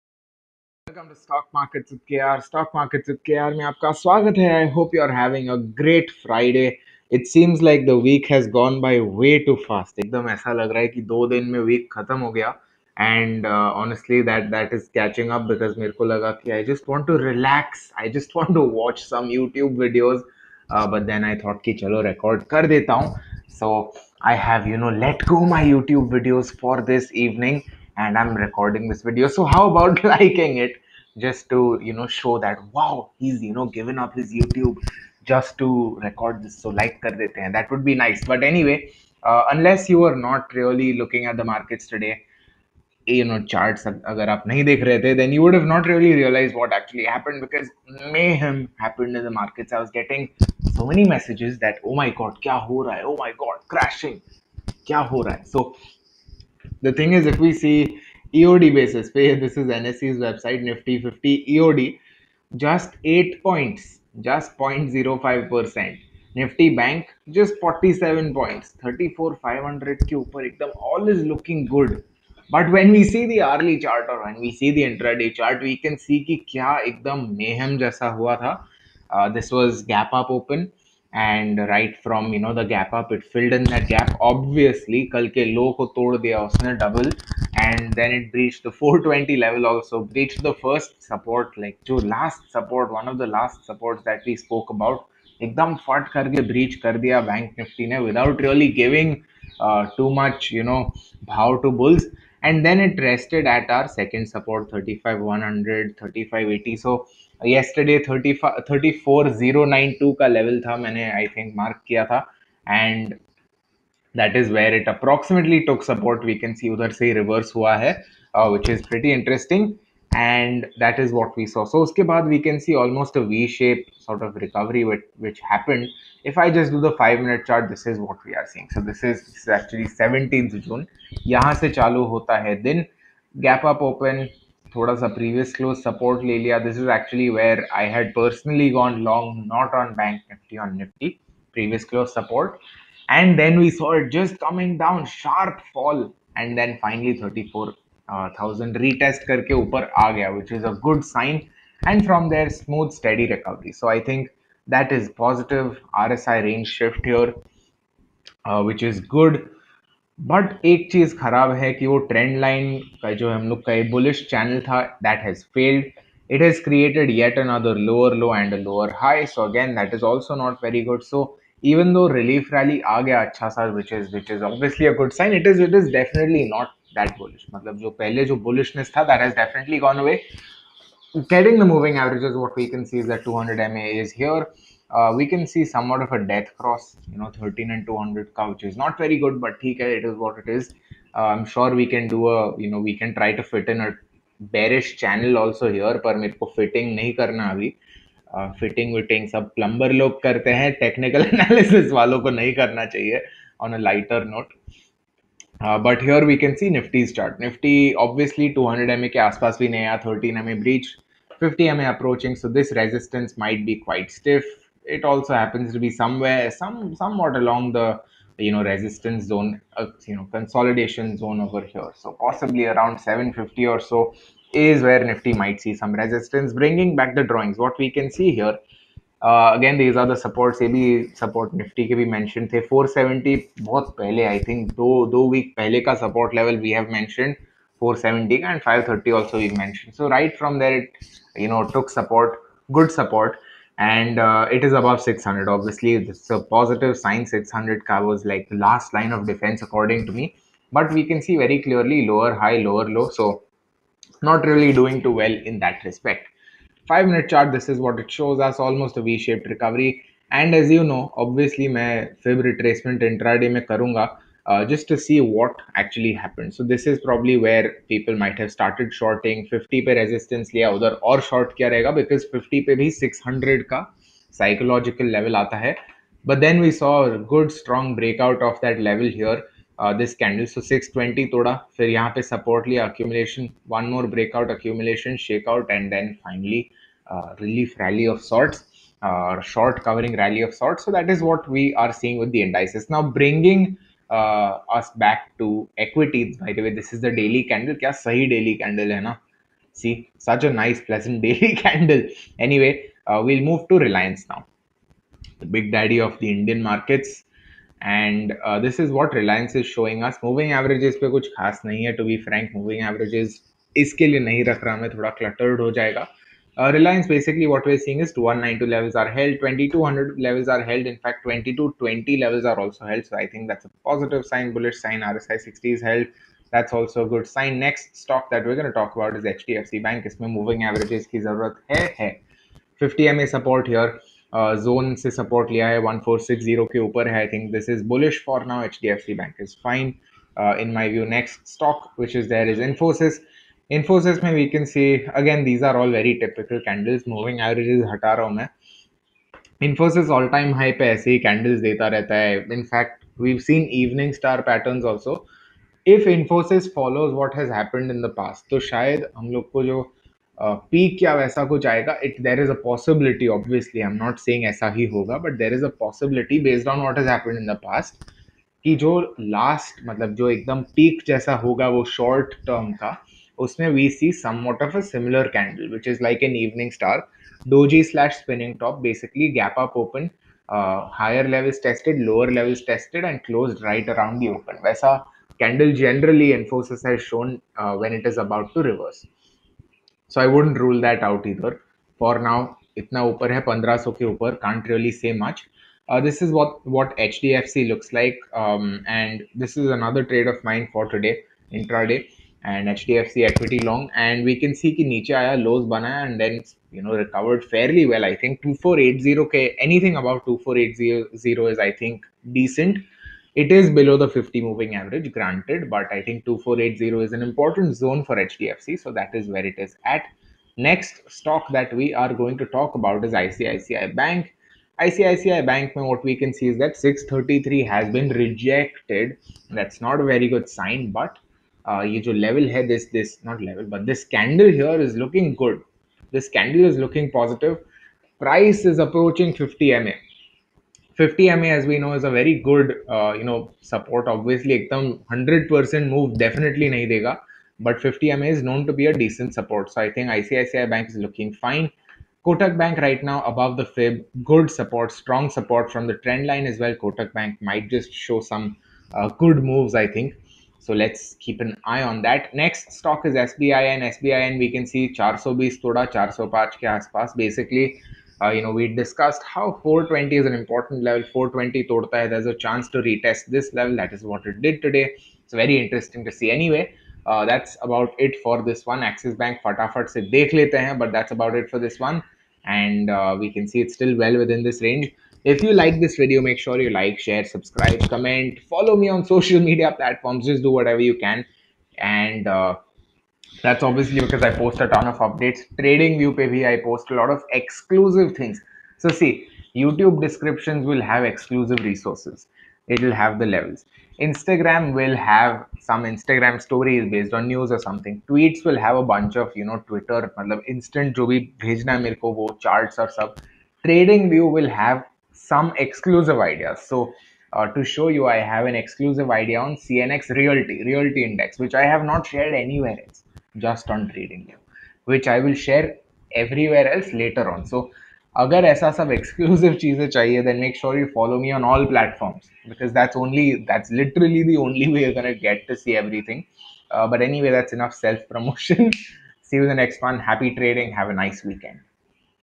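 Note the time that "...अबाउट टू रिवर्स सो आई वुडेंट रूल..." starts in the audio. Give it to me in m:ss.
6:28.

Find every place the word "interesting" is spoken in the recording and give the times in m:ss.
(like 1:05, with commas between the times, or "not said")
1:59, 7:55.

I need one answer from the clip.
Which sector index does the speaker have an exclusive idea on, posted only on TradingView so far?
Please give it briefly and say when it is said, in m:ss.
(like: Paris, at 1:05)
CNX Realty, at 8:39.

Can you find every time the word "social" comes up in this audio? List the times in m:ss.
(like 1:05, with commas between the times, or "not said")
8:09.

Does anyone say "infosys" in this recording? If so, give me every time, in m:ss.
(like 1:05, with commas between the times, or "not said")
5:42.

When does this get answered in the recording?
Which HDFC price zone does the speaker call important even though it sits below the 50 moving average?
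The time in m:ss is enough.
6:56.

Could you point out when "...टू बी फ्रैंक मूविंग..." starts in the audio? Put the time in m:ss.
5:11.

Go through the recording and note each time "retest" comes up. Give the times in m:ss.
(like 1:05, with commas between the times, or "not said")
2:28, 7:52.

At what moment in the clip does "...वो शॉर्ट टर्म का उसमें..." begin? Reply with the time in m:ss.
6:11.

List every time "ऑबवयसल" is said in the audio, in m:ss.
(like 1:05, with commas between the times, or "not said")
1:24, 2:54, 3:28, 6:03, 7:24.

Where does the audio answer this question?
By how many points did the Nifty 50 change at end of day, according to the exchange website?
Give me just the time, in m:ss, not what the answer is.
1:02.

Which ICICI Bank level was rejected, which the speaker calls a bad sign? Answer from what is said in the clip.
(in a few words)
633.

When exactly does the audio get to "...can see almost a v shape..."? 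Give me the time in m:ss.
2:02.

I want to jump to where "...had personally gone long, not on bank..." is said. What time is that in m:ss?
2:17.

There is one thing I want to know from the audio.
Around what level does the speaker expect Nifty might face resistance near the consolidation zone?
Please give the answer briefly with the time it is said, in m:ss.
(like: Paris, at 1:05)
750, at 3:42.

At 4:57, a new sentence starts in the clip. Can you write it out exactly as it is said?
क्या सही daily candle है ना?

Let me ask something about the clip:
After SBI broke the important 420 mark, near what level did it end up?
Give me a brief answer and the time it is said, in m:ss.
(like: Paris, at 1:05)
405, at 7:45.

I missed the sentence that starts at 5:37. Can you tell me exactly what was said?
I think this is bullish for now.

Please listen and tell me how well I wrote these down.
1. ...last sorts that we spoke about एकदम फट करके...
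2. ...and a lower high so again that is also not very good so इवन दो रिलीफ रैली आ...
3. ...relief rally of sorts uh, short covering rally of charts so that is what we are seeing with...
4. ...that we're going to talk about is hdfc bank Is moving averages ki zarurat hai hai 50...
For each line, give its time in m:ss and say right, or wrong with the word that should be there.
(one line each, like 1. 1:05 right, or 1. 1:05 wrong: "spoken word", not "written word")
1. 1:33 wrong: "supports", not "sorts"
2. 2:48 right
3. 4:47 wrong: "sorts", not "charts"
4. 5:28 right.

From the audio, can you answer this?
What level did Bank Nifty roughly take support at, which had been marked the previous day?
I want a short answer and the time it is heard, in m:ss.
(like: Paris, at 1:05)
34092, at 1:48.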